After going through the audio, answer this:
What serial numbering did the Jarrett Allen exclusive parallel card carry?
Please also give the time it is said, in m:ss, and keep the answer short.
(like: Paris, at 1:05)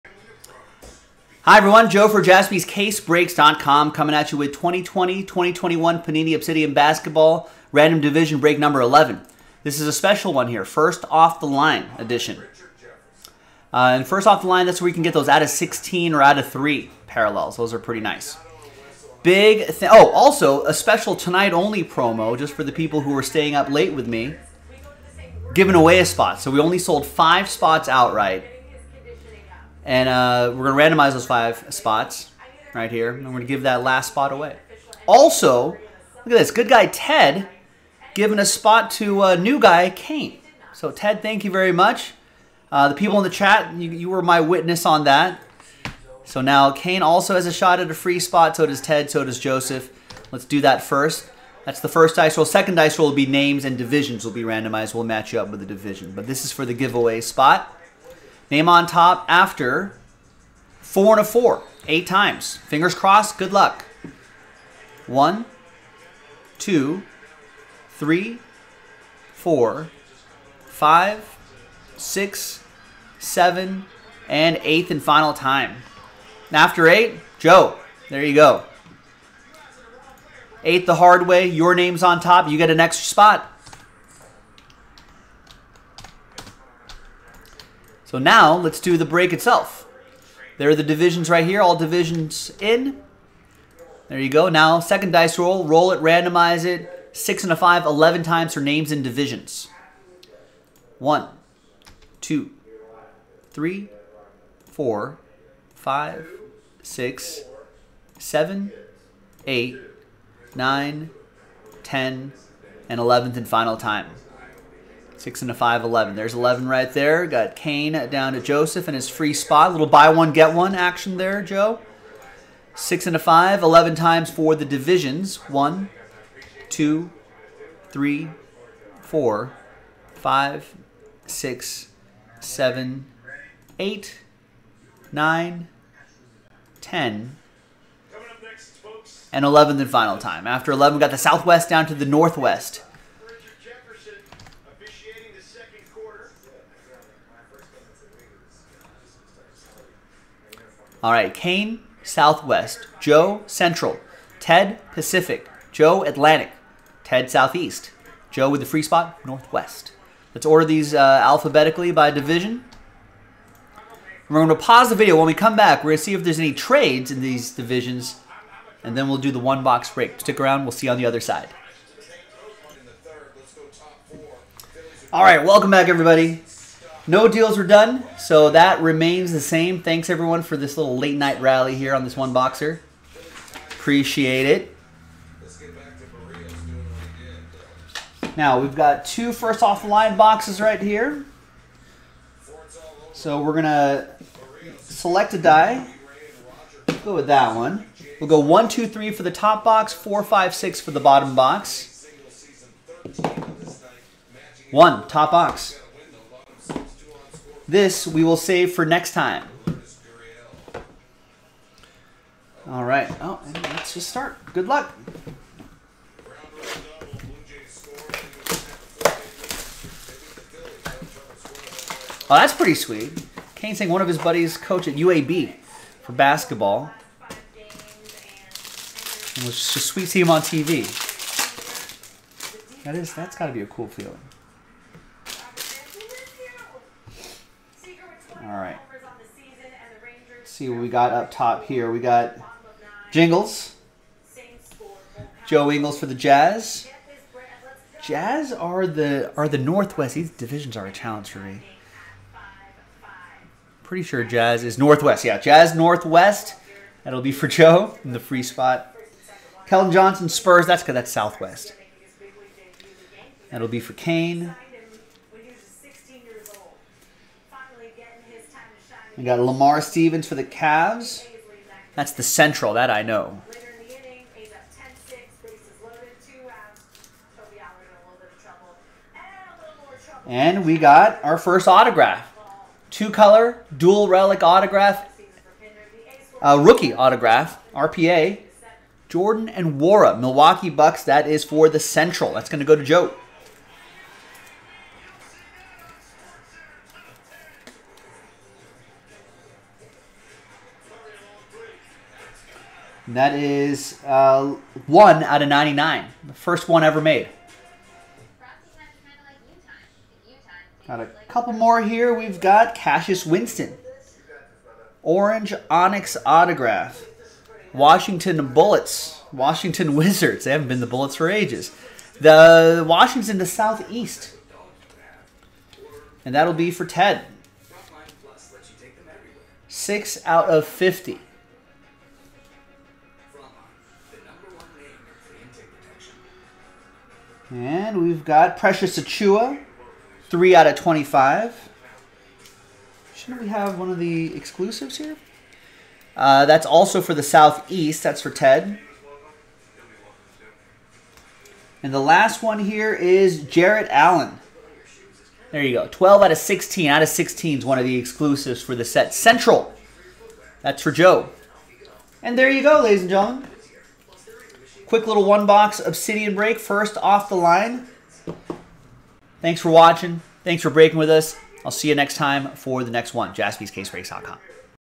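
12/16, at 5:55.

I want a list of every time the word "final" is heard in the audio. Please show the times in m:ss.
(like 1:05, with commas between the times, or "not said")
1:15, 1:53, 2:19.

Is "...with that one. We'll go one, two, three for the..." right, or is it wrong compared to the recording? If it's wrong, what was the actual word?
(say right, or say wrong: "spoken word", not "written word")
right.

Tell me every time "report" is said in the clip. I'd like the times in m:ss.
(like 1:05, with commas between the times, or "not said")
not said.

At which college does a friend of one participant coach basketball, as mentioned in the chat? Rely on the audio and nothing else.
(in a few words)
UAB.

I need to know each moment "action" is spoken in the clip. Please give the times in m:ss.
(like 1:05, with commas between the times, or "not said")
2:00.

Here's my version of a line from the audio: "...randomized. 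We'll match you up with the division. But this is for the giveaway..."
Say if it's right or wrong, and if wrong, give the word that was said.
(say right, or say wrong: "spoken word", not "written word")
right.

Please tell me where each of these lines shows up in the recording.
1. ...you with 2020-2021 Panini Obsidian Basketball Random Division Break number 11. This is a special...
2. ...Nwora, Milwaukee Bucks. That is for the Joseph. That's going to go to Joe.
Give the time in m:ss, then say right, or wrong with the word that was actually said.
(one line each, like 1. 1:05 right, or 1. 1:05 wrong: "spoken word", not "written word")
1. 0:04 right
2. 4:49 wrong: "Central", not "Joseph".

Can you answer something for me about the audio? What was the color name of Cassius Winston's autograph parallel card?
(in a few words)
Orange Onyx.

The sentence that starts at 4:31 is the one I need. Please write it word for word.
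That's the central, that I know.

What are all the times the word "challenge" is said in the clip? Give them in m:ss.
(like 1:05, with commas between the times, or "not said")
4:10.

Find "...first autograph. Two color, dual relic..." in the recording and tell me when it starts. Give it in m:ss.
4:41.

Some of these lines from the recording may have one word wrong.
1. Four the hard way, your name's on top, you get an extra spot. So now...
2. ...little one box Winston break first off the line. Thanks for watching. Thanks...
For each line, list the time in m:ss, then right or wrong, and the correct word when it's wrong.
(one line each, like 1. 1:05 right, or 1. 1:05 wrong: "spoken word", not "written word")
1. 1:20 wrong: "Eight", not "Four"
2. 6:05 wrong: "Obsidian", not "Winston".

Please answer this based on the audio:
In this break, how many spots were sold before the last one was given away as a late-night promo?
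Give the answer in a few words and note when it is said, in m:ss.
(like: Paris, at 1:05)
5, at 0:27.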